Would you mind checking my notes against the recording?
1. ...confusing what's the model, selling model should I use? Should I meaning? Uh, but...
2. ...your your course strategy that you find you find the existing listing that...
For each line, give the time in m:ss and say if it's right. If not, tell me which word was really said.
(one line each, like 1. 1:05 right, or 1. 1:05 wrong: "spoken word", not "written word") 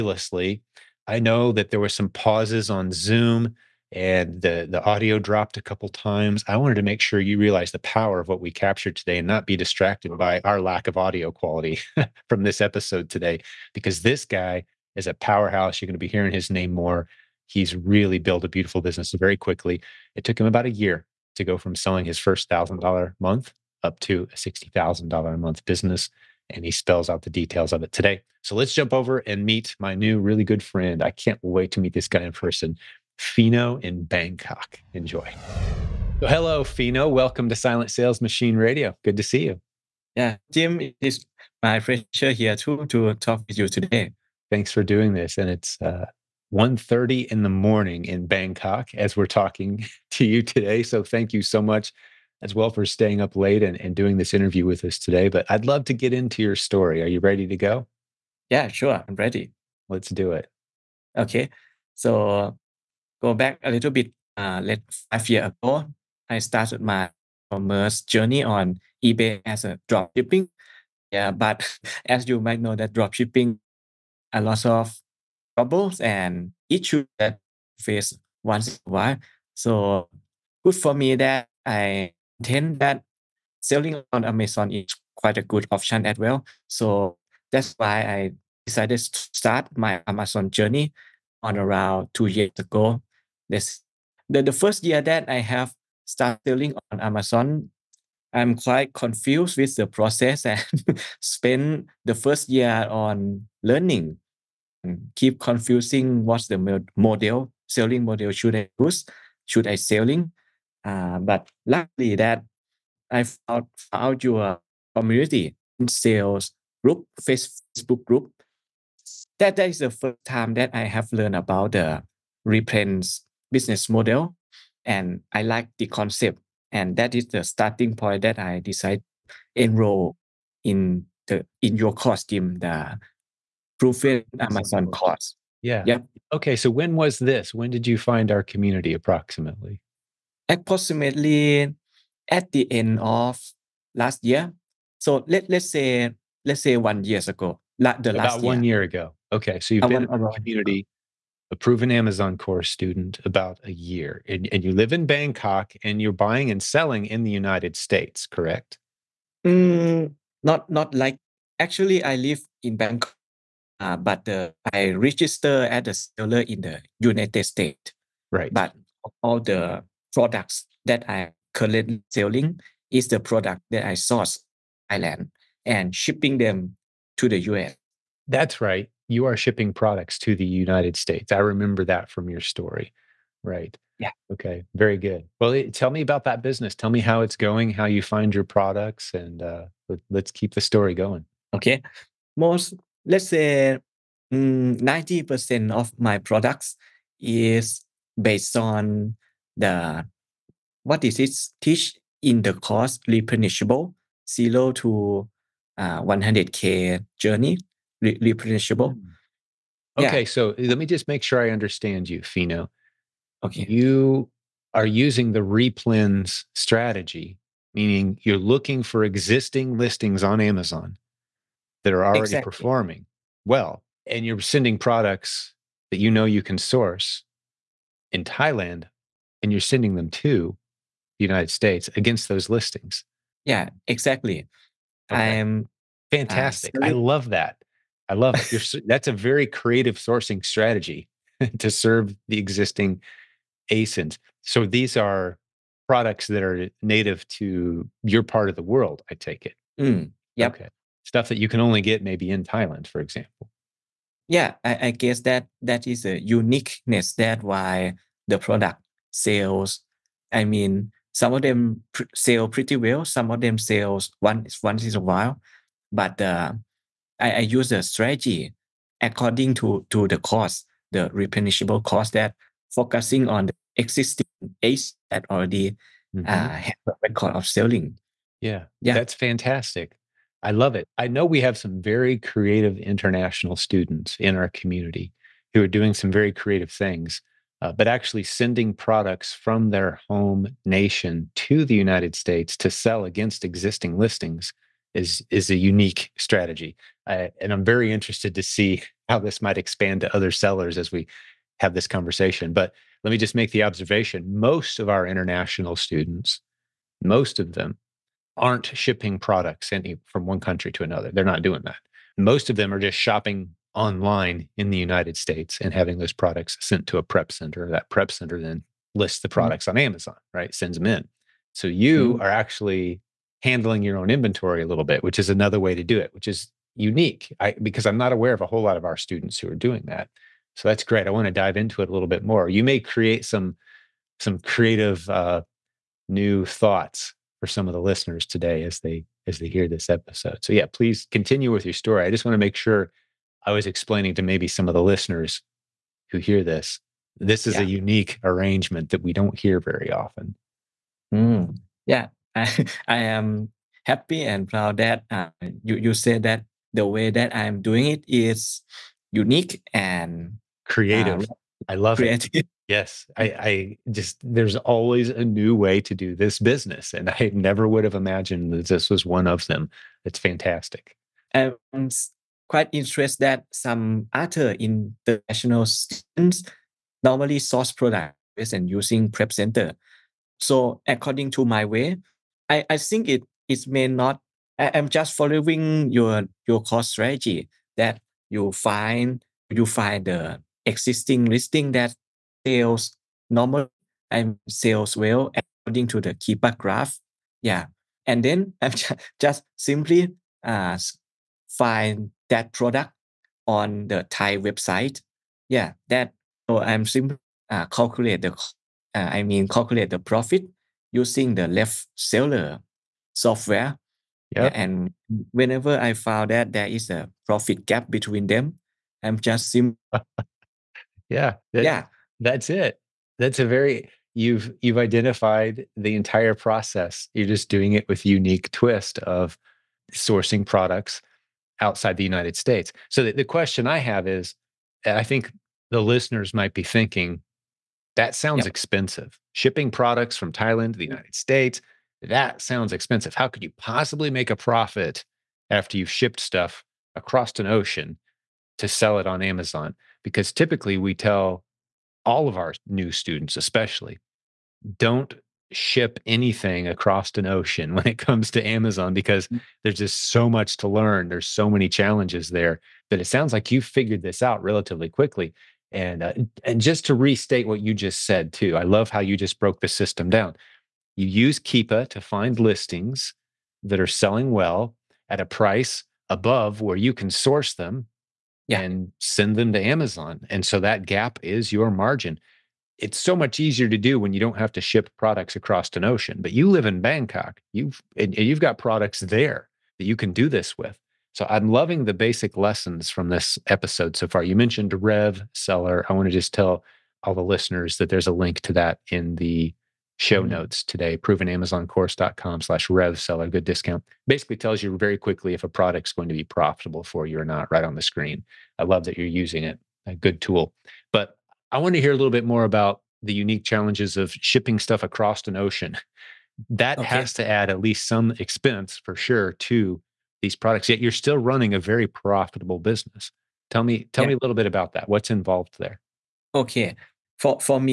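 1. 1:45 wrong: "selling", not "meaning"
2. 6:25 right.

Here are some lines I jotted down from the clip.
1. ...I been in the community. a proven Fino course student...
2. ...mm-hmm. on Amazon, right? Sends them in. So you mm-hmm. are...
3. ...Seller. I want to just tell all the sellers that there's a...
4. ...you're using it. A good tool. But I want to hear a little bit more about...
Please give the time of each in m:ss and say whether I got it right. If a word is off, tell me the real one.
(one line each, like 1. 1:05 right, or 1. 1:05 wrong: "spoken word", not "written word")
1. 2:29 wrong: "Amazon", not "Fino"
2. 5:19 right
3. 8:15 wrong: "listeners", not "sellers"
4. 8:28 right.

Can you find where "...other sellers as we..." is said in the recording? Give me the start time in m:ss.
5:00.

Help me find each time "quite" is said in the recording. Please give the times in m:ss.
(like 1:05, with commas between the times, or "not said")
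1:25, 1:38, 6:12.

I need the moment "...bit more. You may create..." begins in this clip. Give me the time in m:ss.
5:32.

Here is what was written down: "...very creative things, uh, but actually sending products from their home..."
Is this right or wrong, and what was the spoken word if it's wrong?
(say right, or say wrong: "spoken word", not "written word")
right.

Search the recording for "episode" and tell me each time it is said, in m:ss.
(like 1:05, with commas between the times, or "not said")
0:12, 5:39, 8:13.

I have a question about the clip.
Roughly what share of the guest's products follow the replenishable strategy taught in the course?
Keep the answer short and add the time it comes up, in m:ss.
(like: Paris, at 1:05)
90%, at 3:14.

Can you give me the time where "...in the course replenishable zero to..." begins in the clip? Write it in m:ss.
3:22.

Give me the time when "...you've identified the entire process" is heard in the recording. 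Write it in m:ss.
7:04.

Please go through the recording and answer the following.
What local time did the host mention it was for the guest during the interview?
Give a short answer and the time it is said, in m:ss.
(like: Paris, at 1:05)
1:30 in the morning, at 0:46.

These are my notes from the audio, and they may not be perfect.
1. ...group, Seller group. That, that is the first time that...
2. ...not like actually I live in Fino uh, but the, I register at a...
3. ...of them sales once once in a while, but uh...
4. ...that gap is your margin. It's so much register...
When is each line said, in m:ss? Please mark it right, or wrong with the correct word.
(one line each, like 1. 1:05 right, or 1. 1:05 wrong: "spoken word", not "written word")
1. 1:56 wrong: "Facebook", not "Seller"
2. 2:40 wrong: "Bangkok", not "Fino"
3. 4:23 right
4. 8:00 wrong: "easier", not "register".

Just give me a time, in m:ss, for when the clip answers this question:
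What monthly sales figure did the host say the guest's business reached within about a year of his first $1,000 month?
0:24.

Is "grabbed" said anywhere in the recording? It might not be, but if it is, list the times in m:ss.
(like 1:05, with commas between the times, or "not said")
not said.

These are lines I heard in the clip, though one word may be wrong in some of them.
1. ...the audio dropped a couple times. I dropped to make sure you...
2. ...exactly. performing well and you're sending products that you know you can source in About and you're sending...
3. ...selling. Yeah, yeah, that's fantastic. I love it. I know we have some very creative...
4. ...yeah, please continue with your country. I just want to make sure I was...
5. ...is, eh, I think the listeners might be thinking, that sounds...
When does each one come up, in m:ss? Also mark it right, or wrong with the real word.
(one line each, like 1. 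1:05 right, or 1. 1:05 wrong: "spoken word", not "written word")
1. 0:04 wrong: "wanted", not "dropped"
2. 3:42 wrong: "Thailand", not "About"
3. 4:37 right
4. 5:40 wrong: "story", not "country"
5. 7:14 right.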